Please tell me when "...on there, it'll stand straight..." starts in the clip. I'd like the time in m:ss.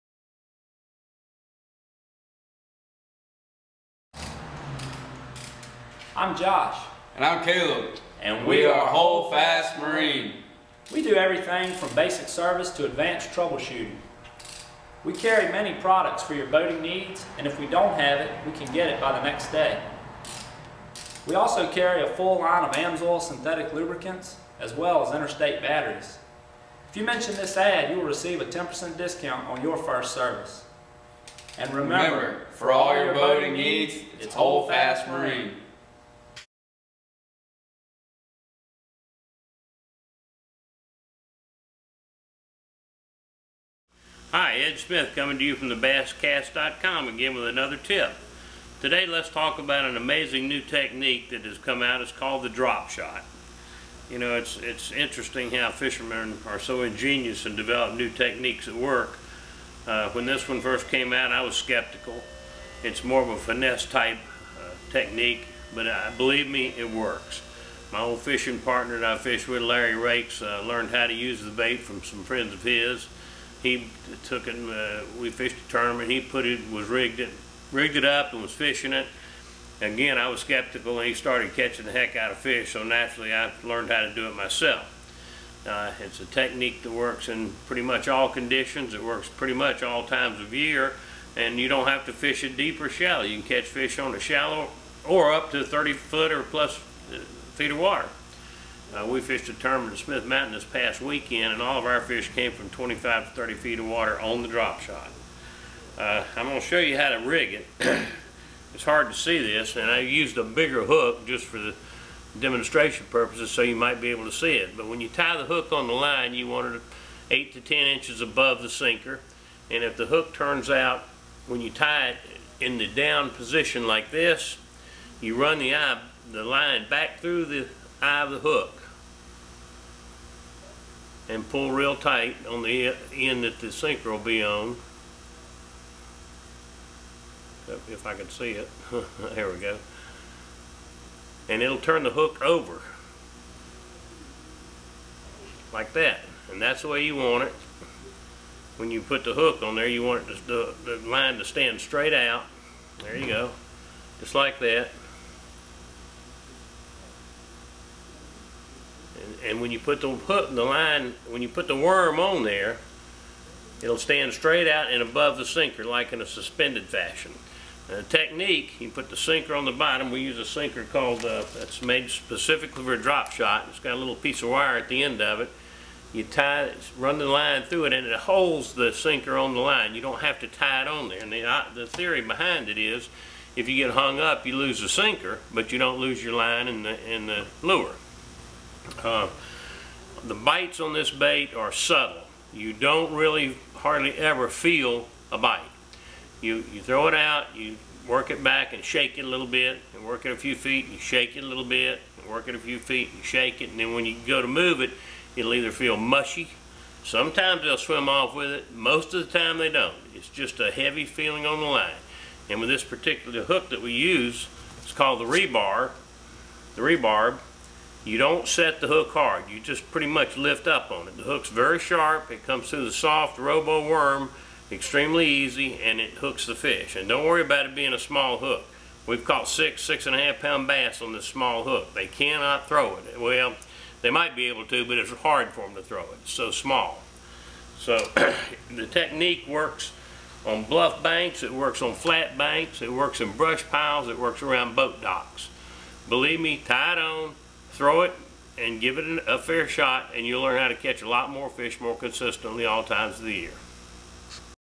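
2:42.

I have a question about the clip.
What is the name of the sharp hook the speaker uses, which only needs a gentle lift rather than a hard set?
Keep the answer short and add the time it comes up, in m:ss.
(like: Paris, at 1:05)
Rebarb, at 3:36.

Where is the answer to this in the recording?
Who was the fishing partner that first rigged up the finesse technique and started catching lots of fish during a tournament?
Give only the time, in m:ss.
1:09.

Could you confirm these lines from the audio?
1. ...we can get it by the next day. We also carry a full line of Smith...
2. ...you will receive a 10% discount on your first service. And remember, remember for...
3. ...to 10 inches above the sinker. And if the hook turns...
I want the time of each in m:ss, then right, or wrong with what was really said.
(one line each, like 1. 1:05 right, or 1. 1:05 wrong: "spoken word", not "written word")
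1. 0:18 wrong: "AMSOIL", not "Smith"
2. 0:27 right
3. 1:57 right.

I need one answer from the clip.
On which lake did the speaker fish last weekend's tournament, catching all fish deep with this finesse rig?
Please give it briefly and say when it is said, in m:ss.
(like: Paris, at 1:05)
Smith Mountain, at 1:39.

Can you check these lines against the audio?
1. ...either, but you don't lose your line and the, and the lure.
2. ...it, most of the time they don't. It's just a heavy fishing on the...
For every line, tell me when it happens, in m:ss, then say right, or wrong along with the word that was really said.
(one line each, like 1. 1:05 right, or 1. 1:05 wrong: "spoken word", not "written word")
1. 3:04 wrong: "sinker", not "either"
2. 3:28 wrong: "feeling", not "fishing".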